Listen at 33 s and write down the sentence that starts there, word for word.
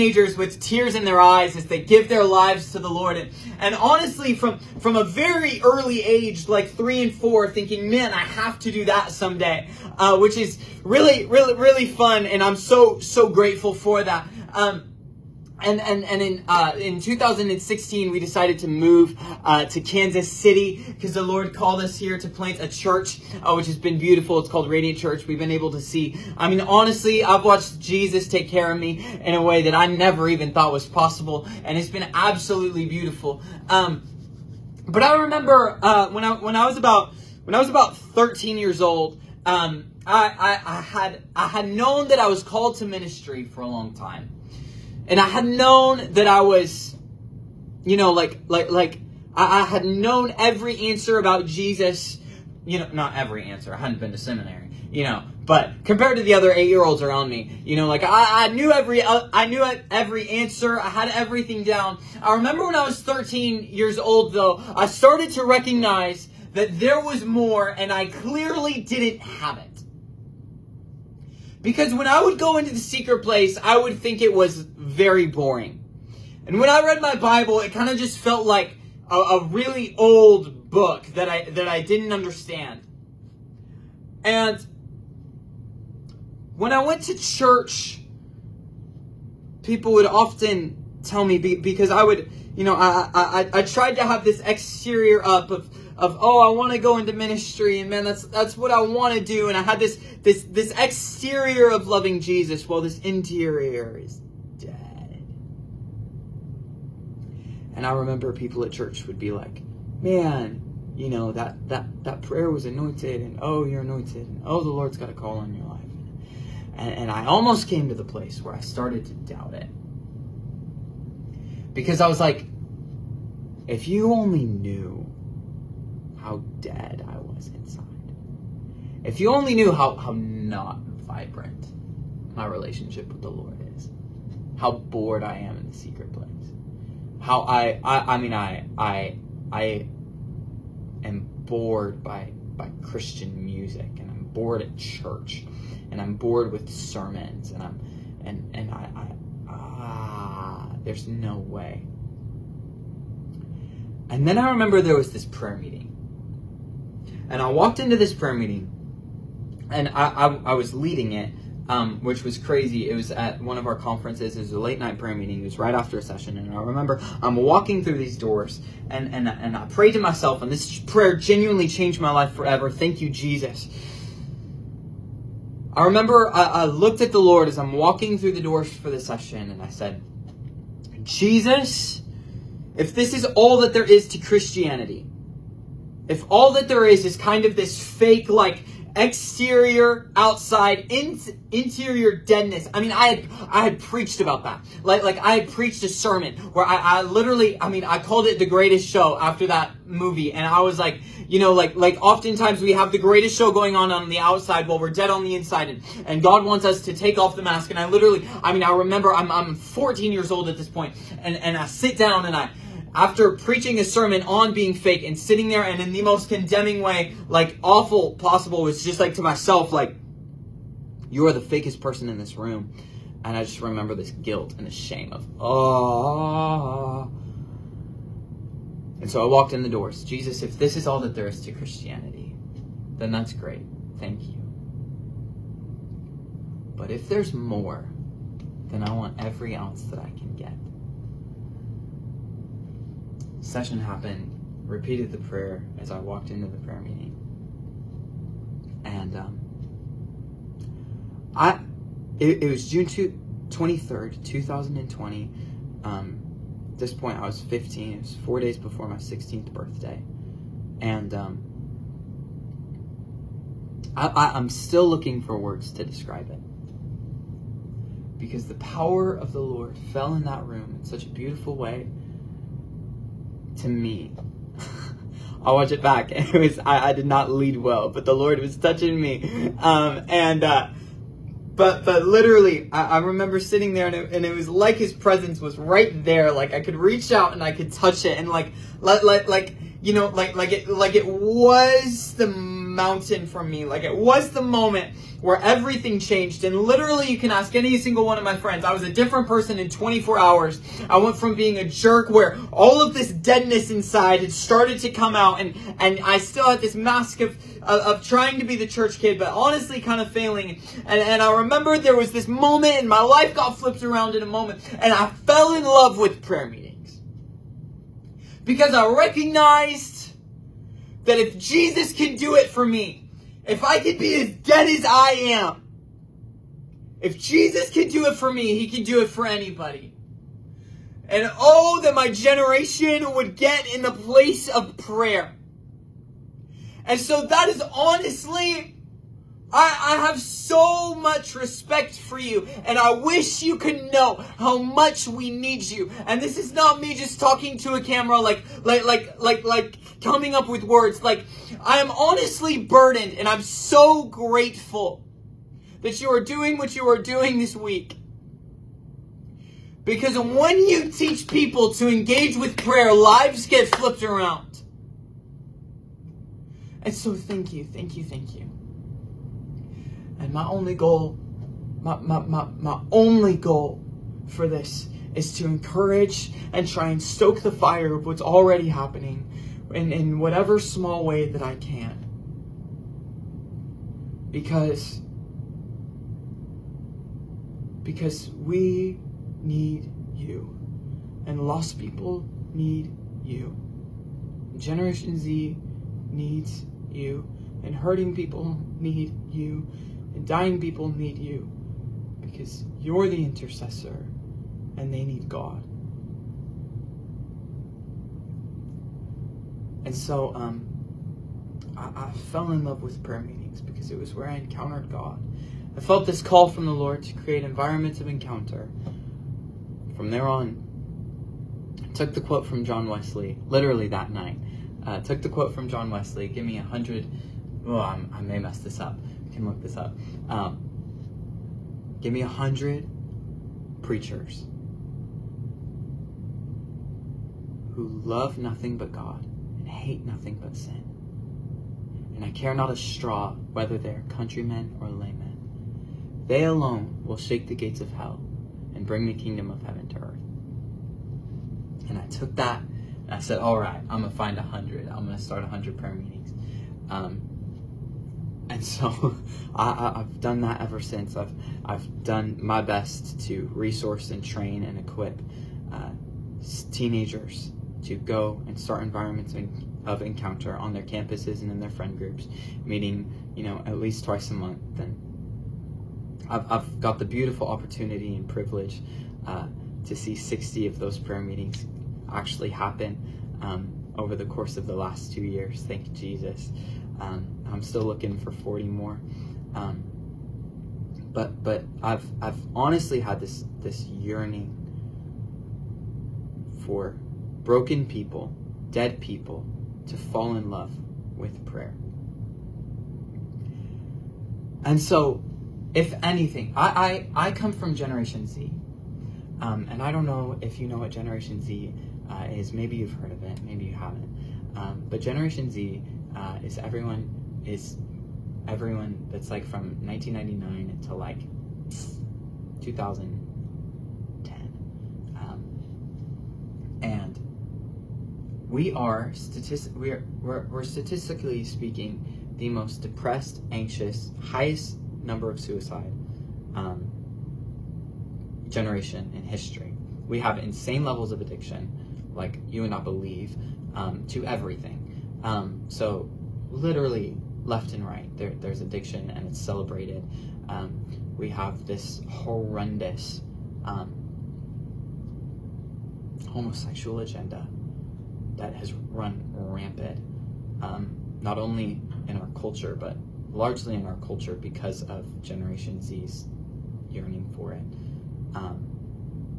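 Um, but I remember uh, when I when I was about when I was about 13 years old.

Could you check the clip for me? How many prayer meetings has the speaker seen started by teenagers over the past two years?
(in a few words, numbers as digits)
60.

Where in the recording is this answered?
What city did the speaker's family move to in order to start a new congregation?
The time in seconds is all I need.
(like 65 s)
19 s.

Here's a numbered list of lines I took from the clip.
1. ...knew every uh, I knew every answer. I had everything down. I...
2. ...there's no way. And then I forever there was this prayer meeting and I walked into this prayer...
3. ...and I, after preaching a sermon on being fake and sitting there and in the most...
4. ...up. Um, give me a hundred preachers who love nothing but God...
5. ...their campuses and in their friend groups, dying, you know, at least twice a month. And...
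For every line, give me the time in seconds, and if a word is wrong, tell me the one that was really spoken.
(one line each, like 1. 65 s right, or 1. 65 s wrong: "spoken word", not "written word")
1. 58 s right
2. 150 s wrong: "remember", not "forever"
3. 212 s right
4. 429 s right
5. 470 s wrong: "meeting", not "dying".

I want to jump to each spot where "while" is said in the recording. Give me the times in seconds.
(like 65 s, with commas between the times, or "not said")
102 s, 204 s.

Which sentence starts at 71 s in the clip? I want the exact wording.
Because when I would go into the secret place, I would think it was very boring.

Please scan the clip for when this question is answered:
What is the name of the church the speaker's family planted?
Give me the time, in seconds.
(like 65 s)
24 s.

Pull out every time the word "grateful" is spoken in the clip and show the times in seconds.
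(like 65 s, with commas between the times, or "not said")
13 s, 354 s.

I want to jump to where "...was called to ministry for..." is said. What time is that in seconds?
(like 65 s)
42 s.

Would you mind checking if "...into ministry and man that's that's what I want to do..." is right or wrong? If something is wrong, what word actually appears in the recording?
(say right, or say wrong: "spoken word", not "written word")
right.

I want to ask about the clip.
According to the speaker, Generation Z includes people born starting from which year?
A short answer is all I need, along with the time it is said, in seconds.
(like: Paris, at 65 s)
1999, at 519 s.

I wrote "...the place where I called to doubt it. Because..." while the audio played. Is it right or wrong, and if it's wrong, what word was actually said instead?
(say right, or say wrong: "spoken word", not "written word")
wrong: "started", not "called".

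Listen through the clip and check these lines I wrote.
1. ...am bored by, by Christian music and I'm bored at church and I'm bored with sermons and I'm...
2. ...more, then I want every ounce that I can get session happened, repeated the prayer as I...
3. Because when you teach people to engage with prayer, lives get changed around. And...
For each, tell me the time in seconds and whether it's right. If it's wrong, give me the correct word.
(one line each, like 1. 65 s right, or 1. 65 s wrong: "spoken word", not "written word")
1. 141 s right
2. 237 s right
3. 359 s wrong: "flipped", not "changed".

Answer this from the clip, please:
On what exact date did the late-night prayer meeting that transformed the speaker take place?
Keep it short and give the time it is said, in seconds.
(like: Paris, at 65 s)
June 23rd, 2020, at 252 s.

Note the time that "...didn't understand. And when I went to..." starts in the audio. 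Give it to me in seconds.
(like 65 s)
81 s.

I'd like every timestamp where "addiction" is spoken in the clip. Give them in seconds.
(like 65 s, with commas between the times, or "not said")
541 s, 548 s.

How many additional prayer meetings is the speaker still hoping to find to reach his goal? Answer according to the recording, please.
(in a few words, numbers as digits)
40.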